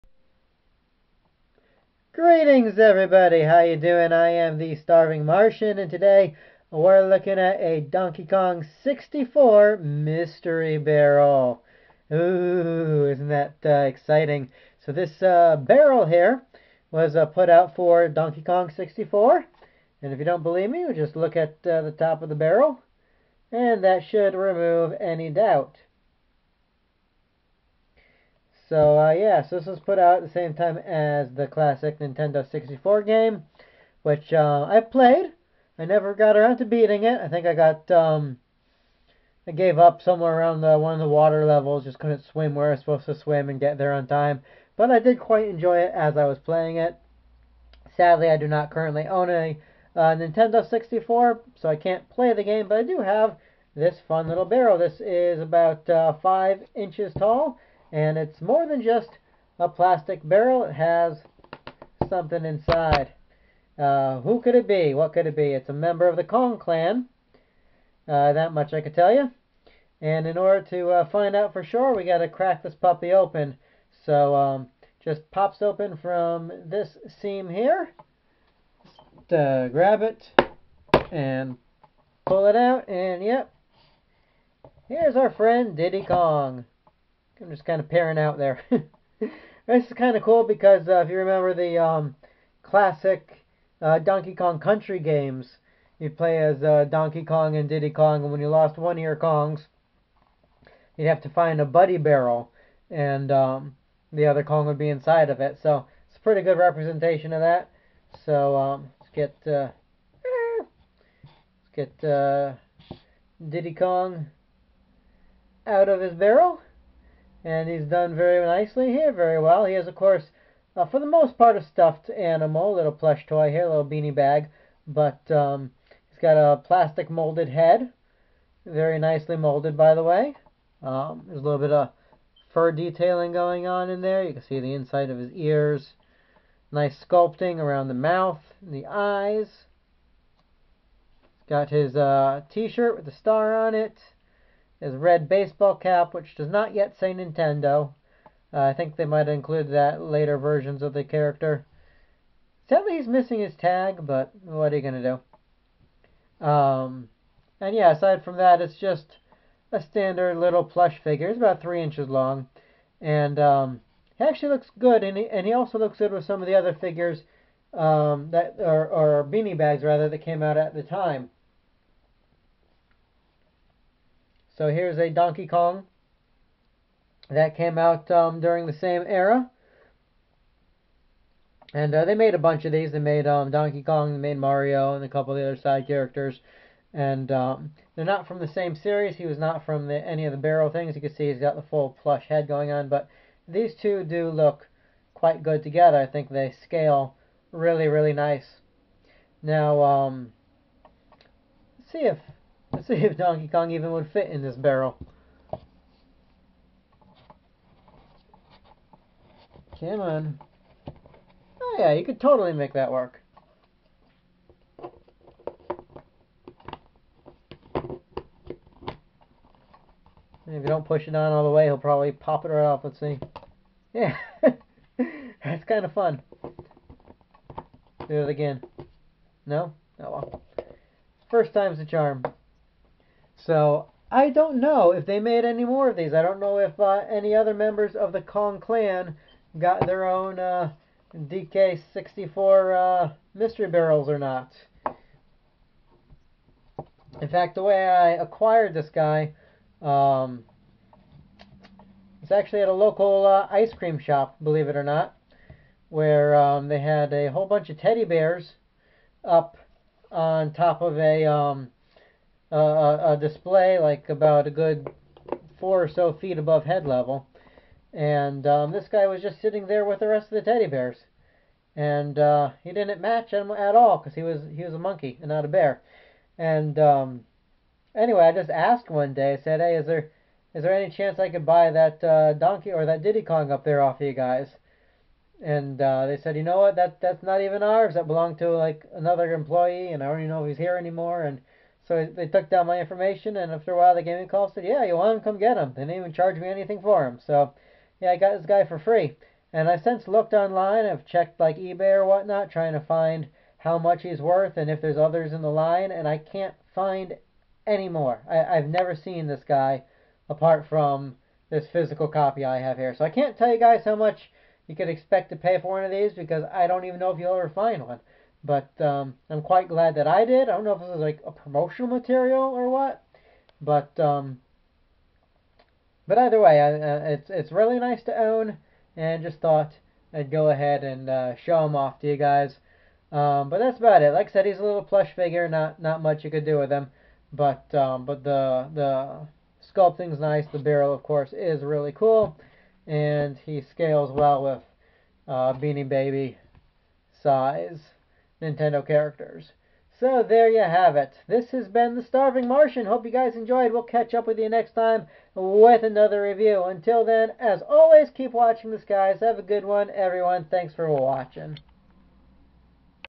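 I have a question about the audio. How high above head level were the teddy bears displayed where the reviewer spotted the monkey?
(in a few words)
4 feet.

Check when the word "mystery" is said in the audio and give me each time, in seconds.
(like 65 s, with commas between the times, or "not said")
9 s, 243 s.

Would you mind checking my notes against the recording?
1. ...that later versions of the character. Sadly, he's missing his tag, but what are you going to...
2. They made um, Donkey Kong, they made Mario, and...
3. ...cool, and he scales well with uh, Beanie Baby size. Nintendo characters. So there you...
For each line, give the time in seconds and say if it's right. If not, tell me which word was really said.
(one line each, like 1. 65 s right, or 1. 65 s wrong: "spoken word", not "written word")
1. 149 s right
2. 182 s right
3. 341 s right.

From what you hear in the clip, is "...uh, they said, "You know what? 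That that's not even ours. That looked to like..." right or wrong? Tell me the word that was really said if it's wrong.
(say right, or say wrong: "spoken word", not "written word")
wrong: "belonged", not "looked".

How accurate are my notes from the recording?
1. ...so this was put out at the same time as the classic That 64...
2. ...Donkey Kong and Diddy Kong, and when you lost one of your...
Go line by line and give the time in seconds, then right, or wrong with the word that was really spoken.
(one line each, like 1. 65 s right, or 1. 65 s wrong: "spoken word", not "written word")
1. 29 s wrong: "Nintendo", not "That"
2. 96 s right.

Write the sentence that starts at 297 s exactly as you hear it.
So yeah, I got this guy for free.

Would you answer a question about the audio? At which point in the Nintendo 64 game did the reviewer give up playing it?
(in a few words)
water levels.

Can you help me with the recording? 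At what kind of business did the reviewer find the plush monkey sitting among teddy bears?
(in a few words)
ice cream shop.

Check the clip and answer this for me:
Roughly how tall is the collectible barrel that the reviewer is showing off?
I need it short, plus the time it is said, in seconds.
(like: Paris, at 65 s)
5 inches, at 56 s.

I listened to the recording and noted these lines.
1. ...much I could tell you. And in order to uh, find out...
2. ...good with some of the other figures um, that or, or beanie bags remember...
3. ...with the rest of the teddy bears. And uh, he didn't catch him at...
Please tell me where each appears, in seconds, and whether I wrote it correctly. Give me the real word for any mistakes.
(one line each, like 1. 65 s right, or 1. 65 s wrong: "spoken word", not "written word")
1. 68 s right
2. 165 s wrong: "rather", not "remember"
3. 269 s wrong: "match", not "catch".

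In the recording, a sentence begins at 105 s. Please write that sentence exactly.
So it's a pretty good representation of that.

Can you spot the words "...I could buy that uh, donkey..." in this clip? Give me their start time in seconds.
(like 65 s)
281 s.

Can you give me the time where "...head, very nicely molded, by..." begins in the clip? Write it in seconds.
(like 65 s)
127 s.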